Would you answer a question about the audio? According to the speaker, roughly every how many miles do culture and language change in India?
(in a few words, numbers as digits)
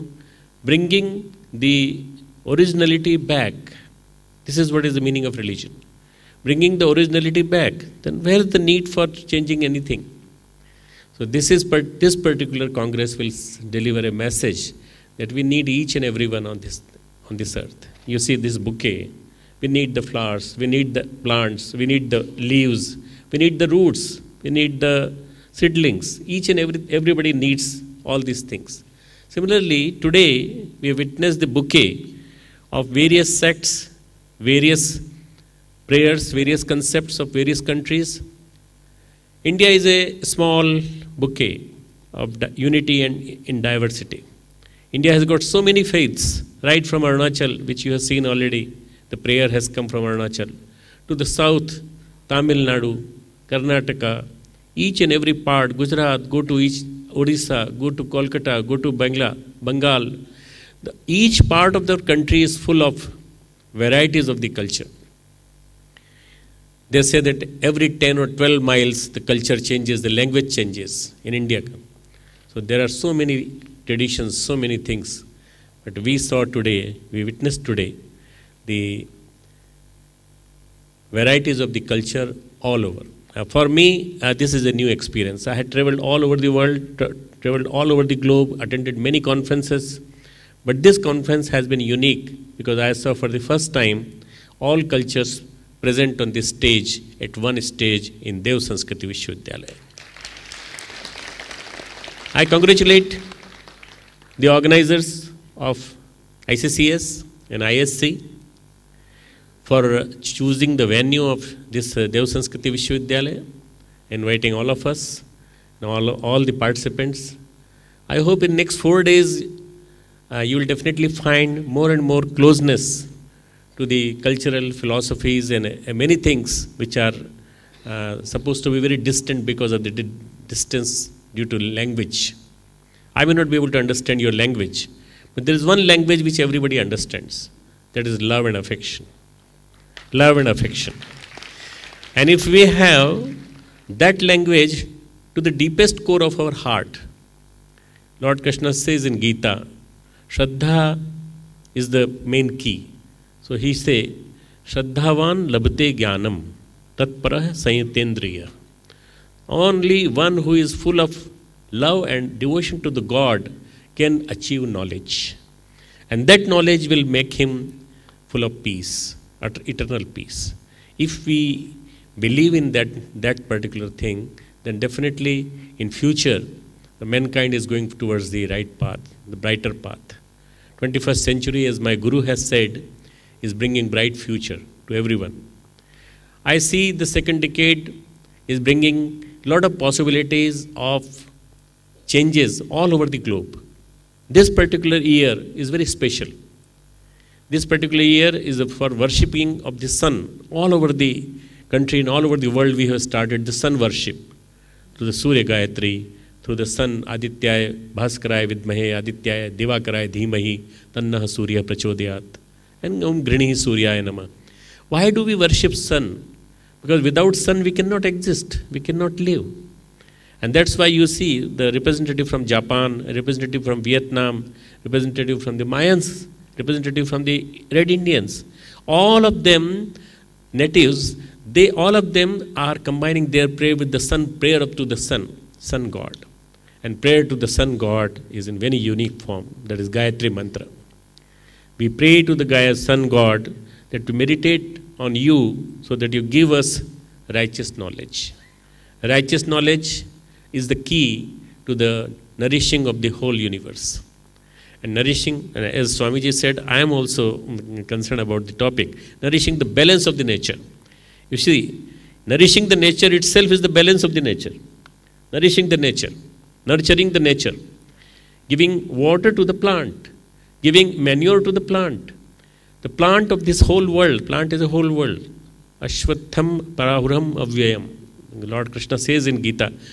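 10 or 12.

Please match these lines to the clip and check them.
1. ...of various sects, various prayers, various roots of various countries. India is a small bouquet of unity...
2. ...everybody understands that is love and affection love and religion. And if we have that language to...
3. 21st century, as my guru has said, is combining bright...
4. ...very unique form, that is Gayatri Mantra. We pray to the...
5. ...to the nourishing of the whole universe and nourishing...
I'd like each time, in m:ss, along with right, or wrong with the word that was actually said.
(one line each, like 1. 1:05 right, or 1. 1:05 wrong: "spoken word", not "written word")
1. 0:32 wrong: "concepts", not "roots"
2. 2:16 wrong: "affection", not "religion"
3. 3:00 wrong: "bringing", not "combining"
4. 3:58 right
5. 4:11 right.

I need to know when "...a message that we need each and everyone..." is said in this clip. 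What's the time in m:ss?
0:14.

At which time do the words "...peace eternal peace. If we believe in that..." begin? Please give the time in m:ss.
2:48.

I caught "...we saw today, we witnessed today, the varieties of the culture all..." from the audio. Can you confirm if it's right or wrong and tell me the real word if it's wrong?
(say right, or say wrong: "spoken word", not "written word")
right.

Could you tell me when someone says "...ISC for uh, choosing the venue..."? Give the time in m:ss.
1:47.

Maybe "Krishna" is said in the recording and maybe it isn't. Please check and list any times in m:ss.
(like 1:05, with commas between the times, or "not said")
2:28, 4:38.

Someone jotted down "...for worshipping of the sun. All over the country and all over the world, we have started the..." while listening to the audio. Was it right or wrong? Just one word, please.
right.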